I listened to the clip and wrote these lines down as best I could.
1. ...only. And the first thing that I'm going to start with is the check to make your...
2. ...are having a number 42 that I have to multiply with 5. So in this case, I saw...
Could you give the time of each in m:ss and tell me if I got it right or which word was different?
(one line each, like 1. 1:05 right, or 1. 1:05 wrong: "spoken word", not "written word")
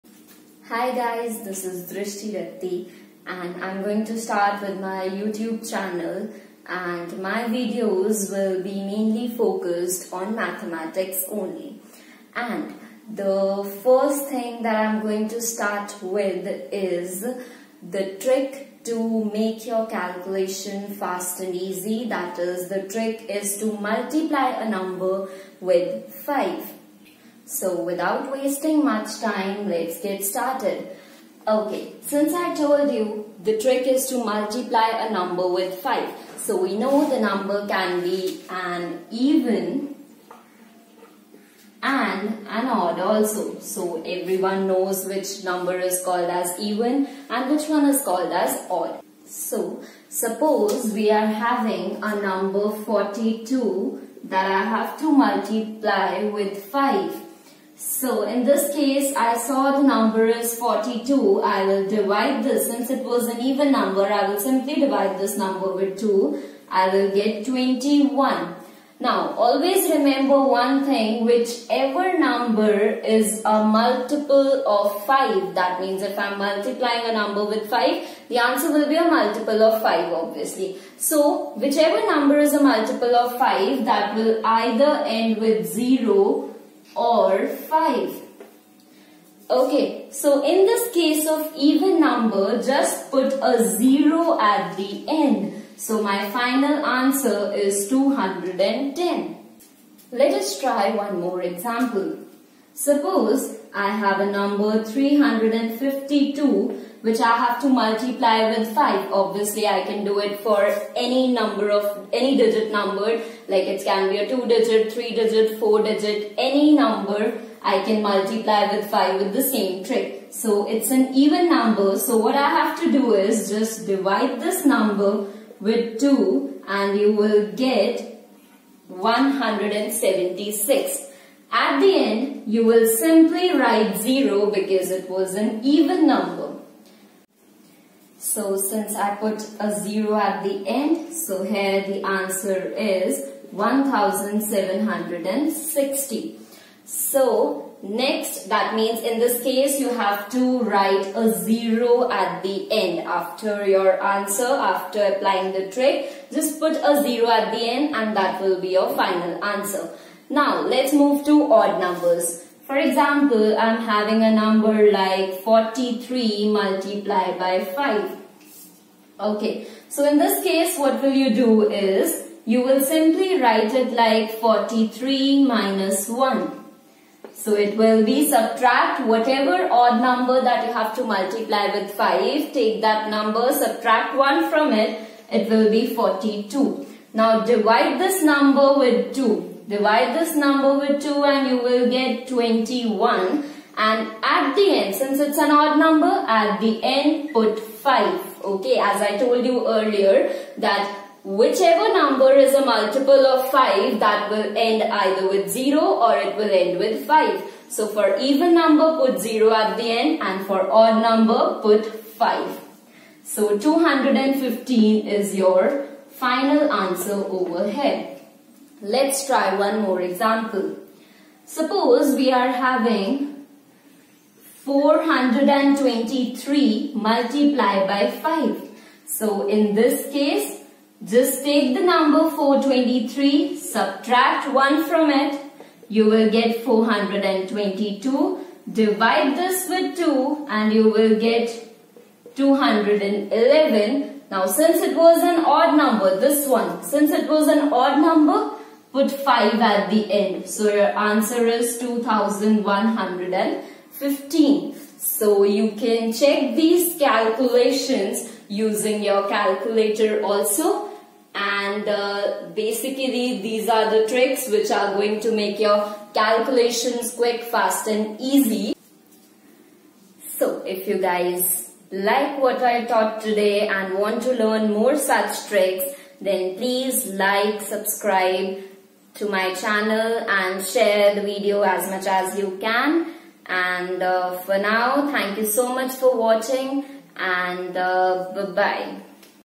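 1. 0:11 wrong: "trick", not "check"
2. 0:51 right.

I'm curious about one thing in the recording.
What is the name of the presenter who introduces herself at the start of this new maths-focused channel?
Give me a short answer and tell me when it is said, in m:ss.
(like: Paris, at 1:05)
Drishti Ratti, at 0:01.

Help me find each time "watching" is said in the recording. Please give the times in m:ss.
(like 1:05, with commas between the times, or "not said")
4:46.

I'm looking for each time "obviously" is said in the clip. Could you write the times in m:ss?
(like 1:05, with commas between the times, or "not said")
1:20, 1:49.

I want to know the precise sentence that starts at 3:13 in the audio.
And at the end, since it's an odd number, at the end put 5.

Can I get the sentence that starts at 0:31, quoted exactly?
Okay, since I told you the trick is to multiply a number with 5.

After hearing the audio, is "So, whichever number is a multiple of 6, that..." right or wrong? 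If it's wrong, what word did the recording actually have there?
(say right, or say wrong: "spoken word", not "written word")
wrong: "5", not "6".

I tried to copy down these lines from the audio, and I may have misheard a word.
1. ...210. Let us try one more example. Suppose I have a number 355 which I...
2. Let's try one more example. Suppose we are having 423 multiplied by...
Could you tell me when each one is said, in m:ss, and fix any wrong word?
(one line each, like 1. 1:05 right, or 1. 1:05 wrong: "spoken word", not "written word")
1. 1:37 wrong: "352", not "355"
2. 3:38 right.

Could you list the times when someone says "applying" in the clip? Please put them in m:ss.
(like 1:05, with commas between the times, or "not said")
2:35.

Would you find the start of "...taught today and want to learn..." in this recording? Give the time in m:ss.
4:32.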